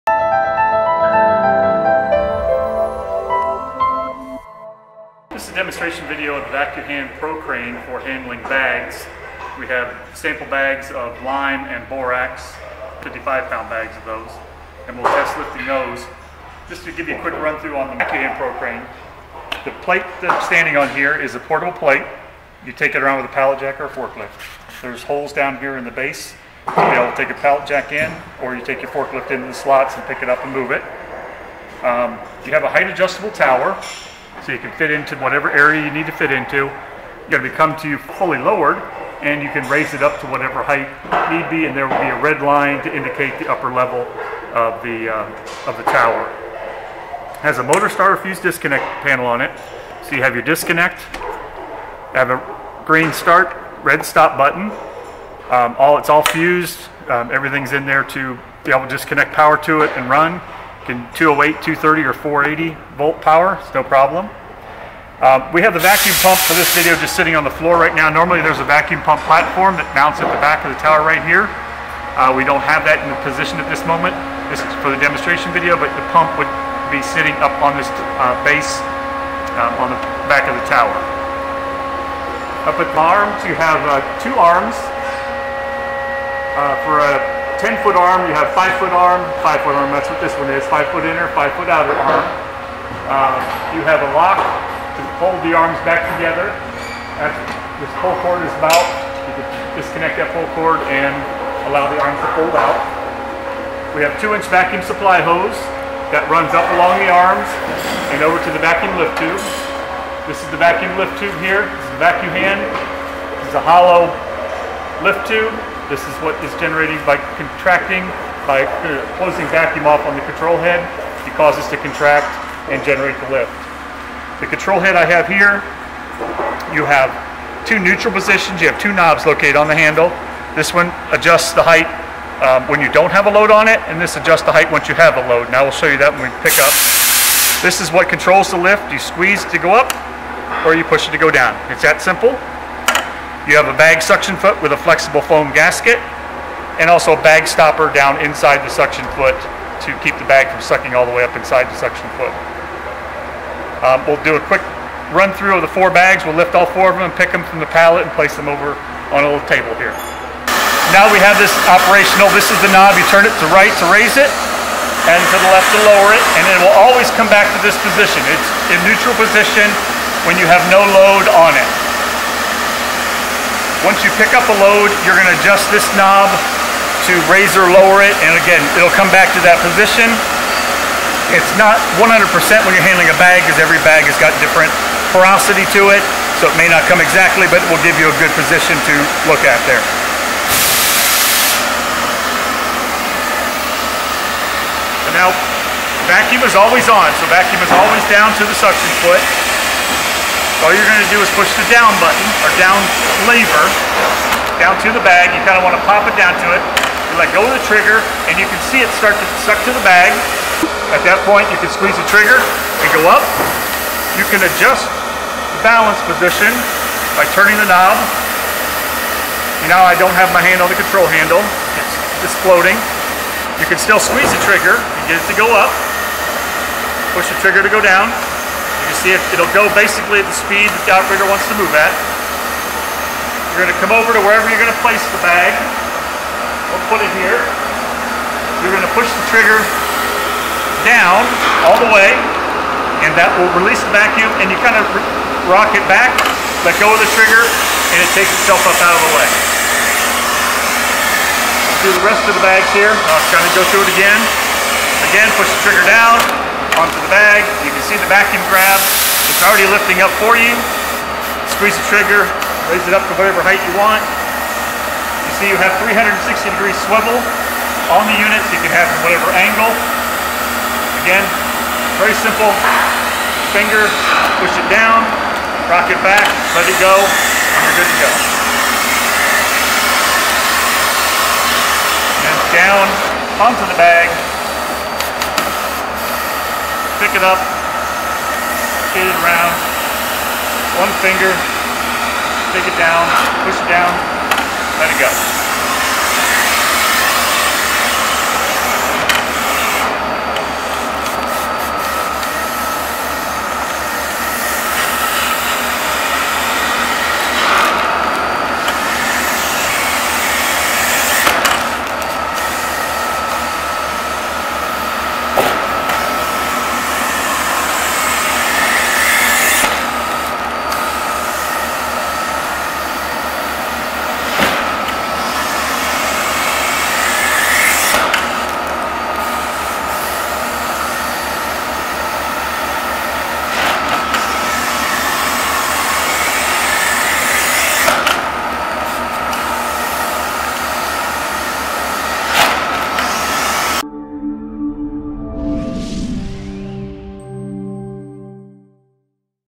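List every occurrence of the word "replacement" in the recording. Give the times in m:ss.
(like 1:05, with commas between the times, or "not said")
not said.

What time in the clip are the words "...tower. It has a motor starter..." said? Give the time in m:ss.
0:45.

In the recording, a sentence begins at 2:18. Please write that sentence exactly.
You squeeze to go up, or you push it to go down.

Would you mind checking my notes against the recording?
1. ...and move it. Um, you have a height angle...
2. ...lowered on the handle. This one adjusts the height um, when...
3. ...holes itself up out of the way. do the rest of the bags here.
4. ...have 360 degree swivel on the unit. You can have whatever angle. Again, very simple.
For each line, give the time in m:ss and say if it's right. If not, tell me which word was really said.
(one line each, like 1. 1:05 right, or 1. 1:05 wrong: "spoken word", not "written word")
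1. 0:30 wrong: "adjustable", not "angle"
2. 2:09 wrong: "located", not "lowered"
3. 4:08 wrong: "takes", not "holes"
4. 4:25 right.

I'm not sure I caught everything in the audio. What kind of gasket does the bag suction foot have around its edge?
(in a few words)
Flexible foam gasket.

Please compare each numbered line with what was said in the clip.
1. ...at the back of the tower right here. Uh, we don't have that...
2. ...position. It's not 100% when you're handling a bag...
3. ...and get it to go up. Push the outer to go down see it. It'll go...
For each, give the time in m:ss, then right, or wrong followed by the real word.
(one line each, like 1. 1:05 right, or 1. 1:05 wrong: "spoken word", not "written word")
1. 1:10 right
2. 2:59 right
3. 3:44 wrong: "trigger", not "outer".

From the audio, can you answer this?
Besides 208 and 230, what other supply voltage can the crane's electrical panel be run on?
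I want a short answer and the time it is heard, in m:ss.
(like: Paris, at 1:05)
480 volts, at 1:02.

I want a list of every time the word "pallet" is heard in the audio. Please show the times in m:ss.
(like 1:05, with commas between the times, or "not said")
0:23, 0:27, 2:37.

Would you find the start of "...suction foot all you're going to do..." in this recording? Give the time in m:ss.
3:18.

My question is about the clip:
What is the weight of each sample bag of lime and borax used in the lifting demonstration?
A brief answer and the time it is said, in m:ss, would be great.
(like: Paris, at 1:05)
55 pounds, at 0:13.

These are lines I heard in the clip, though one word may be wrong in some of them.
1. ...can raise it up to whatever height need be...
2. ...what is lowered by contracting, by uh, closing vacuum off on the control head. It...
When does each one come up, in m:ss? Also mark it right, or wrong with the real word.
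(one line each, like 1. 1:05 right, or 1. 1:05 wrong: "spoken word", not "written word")
1. 0:39 right
2. 1:56 wrong: "generated", not "lowered".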